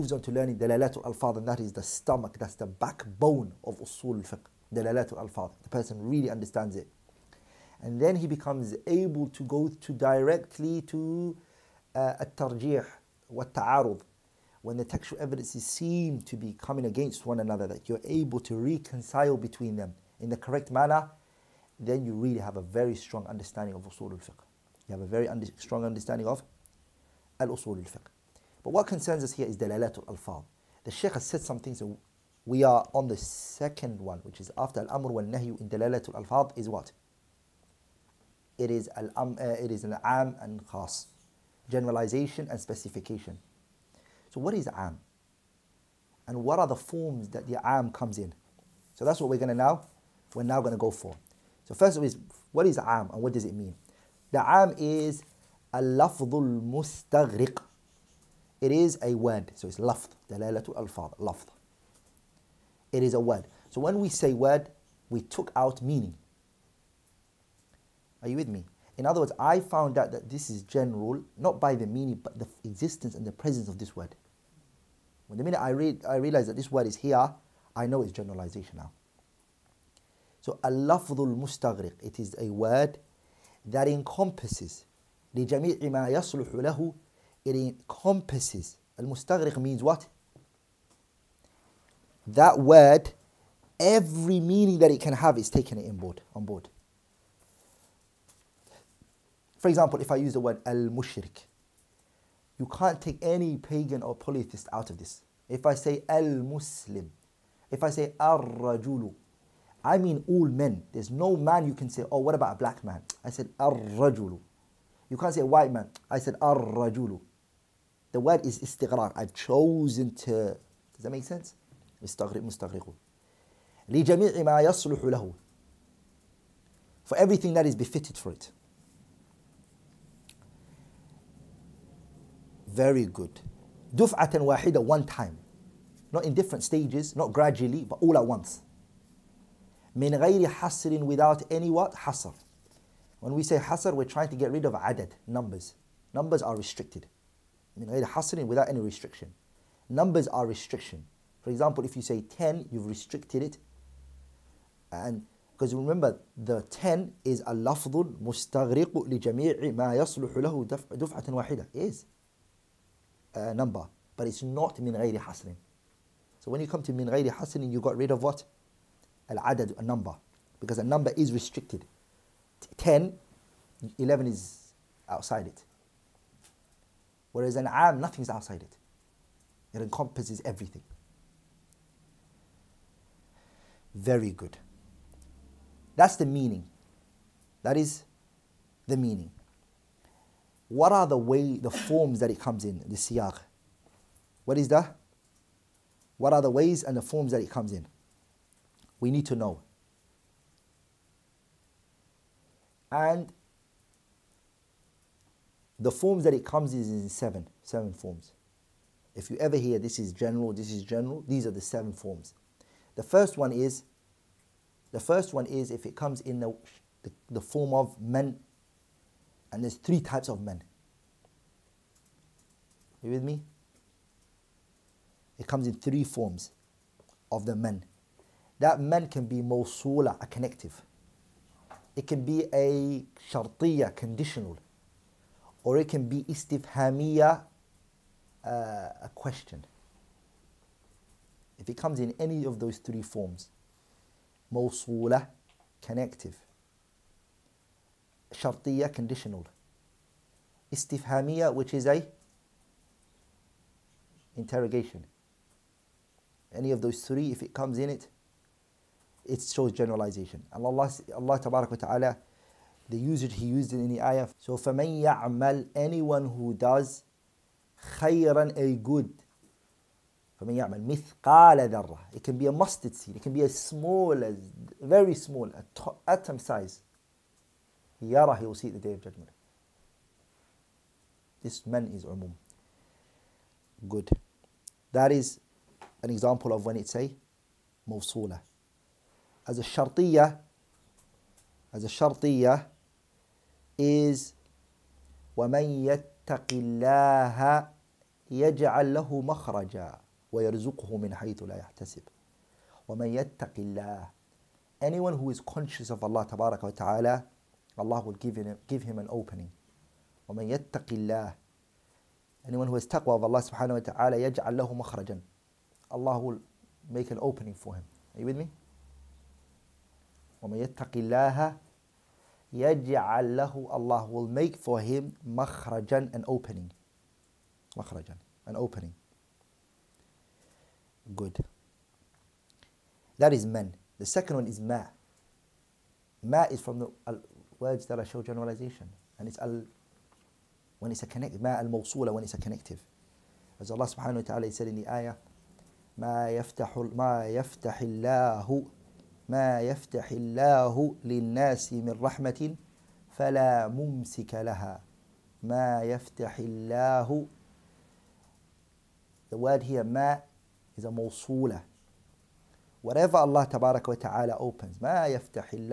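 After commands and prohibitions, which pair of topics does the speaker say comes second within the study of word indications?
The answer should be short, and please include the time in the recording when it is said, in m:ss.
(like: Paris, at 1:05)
Generalization and specification, at 0:41.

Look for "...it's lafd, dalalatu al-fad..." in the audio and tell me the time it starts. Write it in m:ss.
0:59.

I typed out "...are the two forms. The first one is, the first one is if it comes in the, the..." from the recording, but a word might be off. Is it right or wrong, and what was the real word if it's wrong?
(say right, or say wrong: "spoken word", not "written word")
wrong: "seven", not "two".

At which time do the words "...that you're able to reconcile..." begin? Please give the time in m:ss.
0:17.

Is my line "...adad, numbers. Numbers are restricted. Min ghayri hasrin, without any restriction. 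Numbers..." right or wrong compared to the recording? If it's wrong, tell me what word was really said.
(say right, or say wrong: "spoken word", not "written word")
right.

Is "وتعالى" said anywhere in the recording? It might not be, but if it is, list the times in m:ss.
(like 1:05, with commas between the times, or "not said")
4:21, 6:03.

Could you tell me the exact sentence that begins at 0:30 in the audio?
The sheikh has said something, so we are on the second one, which is after al-amr wal-nahyu in dalalat al-alfad is what?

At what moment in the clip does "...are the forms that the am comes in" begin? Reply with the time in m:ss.
0:46.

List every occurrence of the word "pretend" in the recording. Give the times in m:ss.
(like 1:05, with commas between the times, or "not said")
not said.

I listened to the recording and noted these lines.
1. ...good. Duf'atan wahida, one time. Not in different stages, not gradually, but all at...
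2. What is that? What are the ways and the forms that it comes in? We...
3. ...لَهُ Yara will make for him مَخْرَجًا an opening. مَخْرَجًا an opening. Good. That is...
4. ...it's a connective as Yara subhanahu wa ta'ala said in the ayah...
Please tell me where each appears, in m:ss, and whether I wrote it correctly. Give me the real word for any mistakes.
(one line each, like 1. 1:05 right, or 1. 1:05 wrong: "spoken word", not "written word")
1. 2:13 right
2. 3:14 right
3. 5:23 wrong: "Allah", not "Yara"
4. 5:42 wrong: "Allah", not "Yara".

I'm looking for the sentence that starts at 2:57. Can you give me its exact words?
Whereas an am, nothing is outside it.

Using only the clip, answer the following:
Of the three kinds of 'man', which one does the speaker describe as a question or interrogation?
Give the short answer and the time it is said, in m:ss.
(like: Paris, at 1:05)
istifhamiya, at 3:56.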